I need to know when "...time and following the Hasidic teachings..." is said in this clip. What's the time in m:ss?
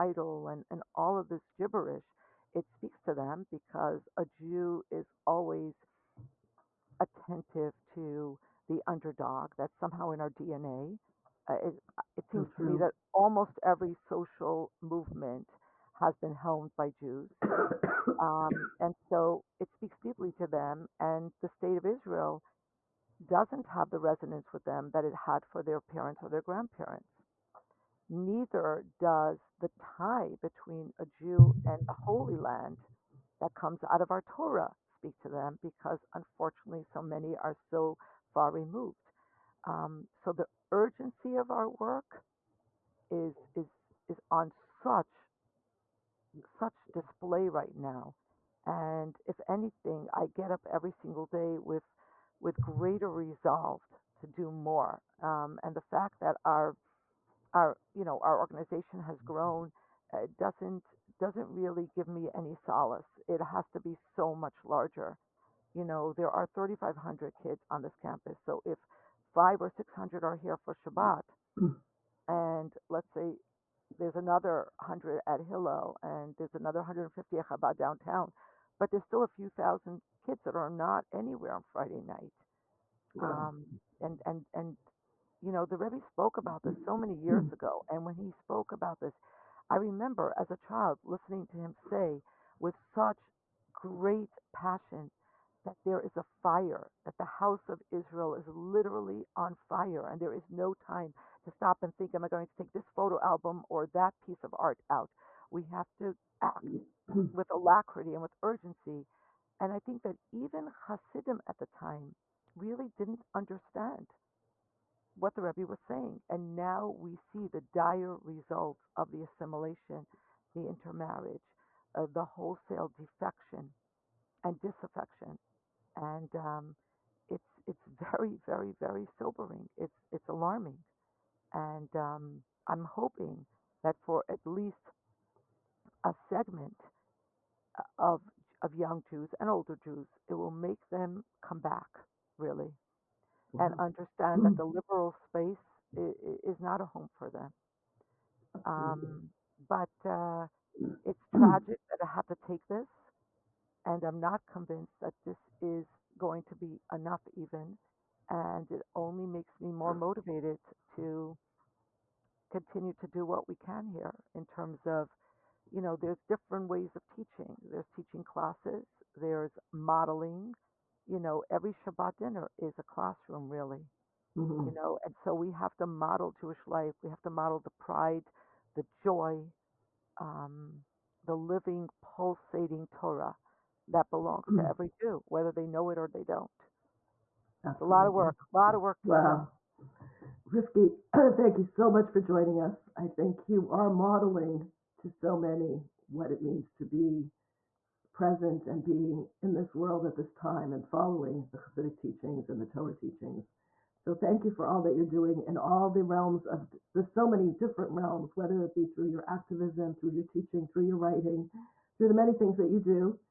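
3:20.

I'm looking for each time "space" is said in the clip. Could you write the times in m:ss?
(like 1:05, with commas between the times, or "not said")
2:25.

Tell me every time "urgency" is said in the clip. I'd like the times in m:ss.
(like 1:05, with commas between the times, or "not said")
0:40, 1:48.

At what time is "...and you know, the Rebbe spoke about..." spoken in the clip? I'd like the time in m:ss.
1:24.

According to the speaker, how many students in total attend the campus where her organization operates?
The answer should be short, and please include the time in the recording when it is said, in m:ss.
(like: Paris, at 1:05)
3,500, at 1:06.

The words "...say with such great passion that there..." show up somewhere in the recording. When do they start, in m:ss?
1:31.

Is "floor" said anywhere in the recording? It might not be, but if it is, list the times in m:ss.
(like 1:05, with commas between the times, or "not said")
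not said.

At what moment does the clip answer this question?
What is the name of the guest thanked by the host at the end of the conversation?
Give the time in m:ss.
3:10.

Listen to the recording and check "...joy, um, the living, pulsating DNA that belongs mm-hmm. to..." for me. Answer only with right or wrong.
wrong.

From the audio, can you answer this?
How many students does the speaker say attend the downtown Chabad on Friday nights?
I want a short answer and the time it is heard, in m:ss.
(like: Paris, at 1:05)
150, at 1:16.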